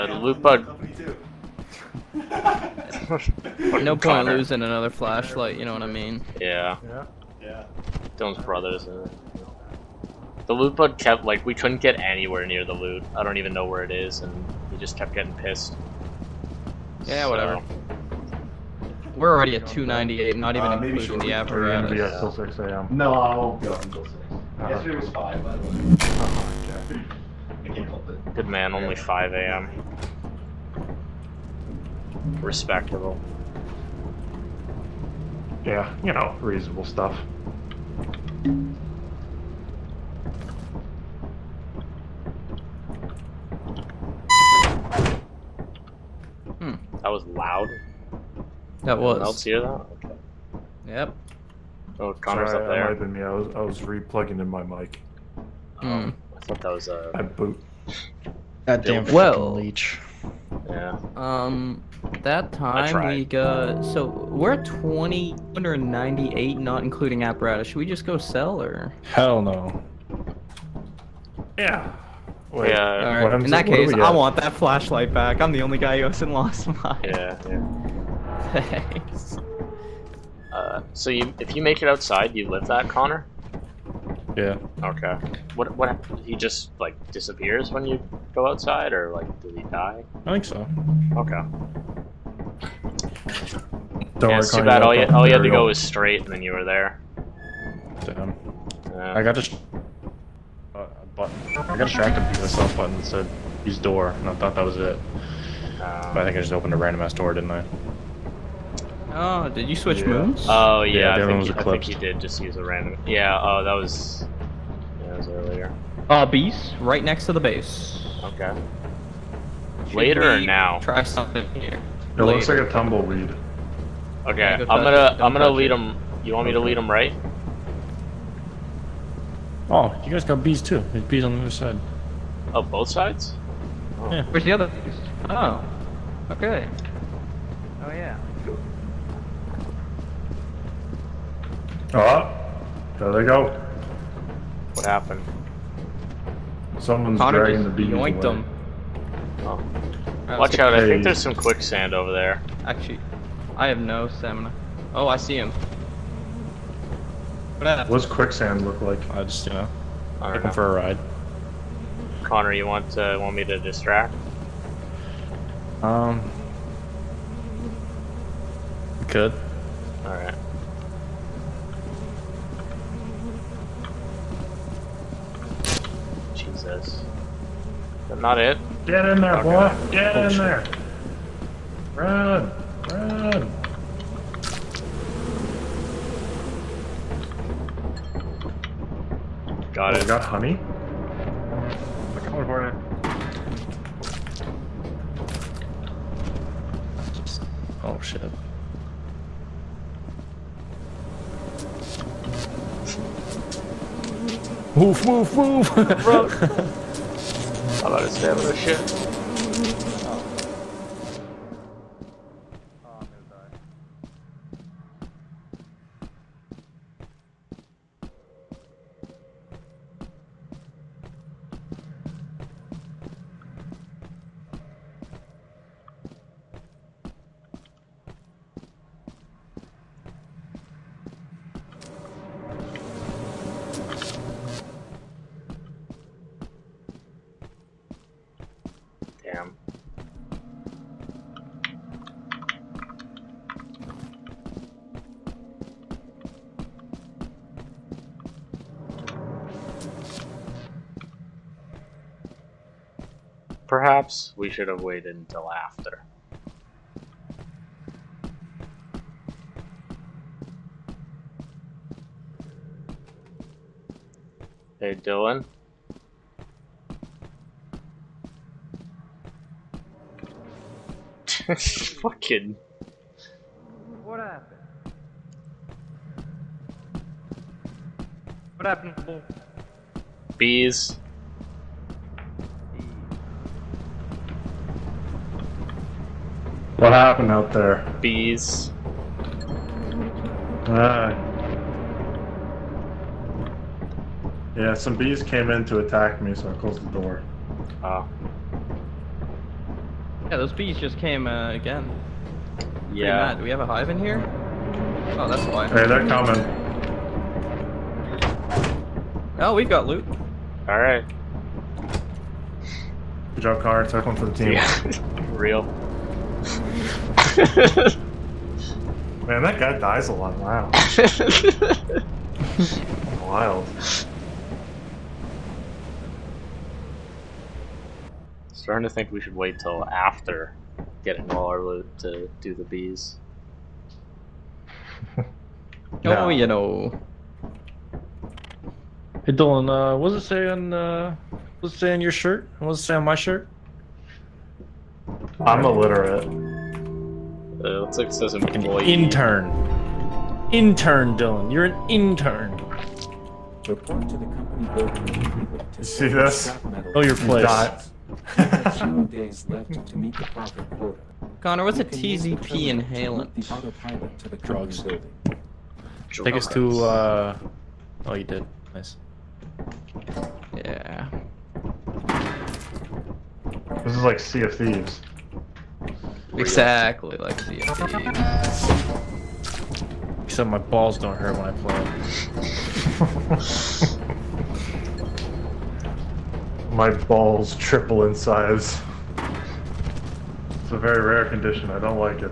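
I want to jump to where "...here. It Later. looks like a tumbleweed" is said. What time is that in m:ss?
2:01.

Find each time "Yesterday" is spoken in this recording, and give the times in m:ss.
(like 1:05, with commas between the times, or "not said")
0:24.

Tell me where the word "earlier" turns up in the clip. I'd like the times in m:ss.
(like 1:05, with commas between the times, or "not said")
1:55.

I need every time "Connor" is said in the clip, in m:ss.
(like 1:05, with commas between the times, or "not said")
0:52, 1:22, 2:27, 2:42, 6:01.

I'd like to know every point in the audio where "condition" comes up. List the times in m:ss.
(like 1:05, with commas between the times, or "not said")
6:31.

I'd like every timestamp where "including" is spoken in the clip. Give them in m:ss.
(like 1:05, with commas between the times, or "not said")
0:20, 1:06.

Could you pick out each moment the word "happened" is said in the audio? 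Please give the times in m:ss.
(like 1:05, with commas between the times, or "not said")
2:24, 4:34, 4:38, 4:46.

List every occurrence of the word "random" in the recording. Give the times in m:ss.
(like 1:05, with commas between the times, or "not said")
1:46, 1:52.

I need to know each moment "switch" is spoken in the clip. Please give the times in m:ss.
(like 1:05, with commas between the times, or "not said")
1:49.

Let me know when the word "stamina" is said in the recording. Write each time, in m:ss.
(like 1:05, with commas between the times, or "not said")
2:34, 3:28.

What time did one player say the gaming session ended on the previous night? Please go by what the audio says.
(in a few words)
5 a.m.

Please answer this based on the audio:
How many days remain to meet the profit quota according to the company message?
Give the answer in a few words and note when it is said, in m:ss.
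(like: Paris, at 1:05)
2, at 5:58.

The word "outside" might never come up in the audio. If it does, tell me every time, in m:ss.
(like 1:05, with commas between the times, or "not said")
1:21, 1:28.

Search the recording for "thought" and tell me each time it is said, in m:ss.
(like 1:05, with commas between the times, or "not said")
0:56, 1:44.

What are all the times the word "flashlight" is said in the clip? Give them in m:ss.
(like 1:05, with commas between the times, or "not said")
0:04, 1:14.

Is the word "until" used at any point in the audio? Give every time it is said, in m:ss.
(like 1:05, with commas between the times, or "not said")
0:23, 4:15.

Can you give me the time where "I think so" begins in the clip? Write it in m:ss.
1:30.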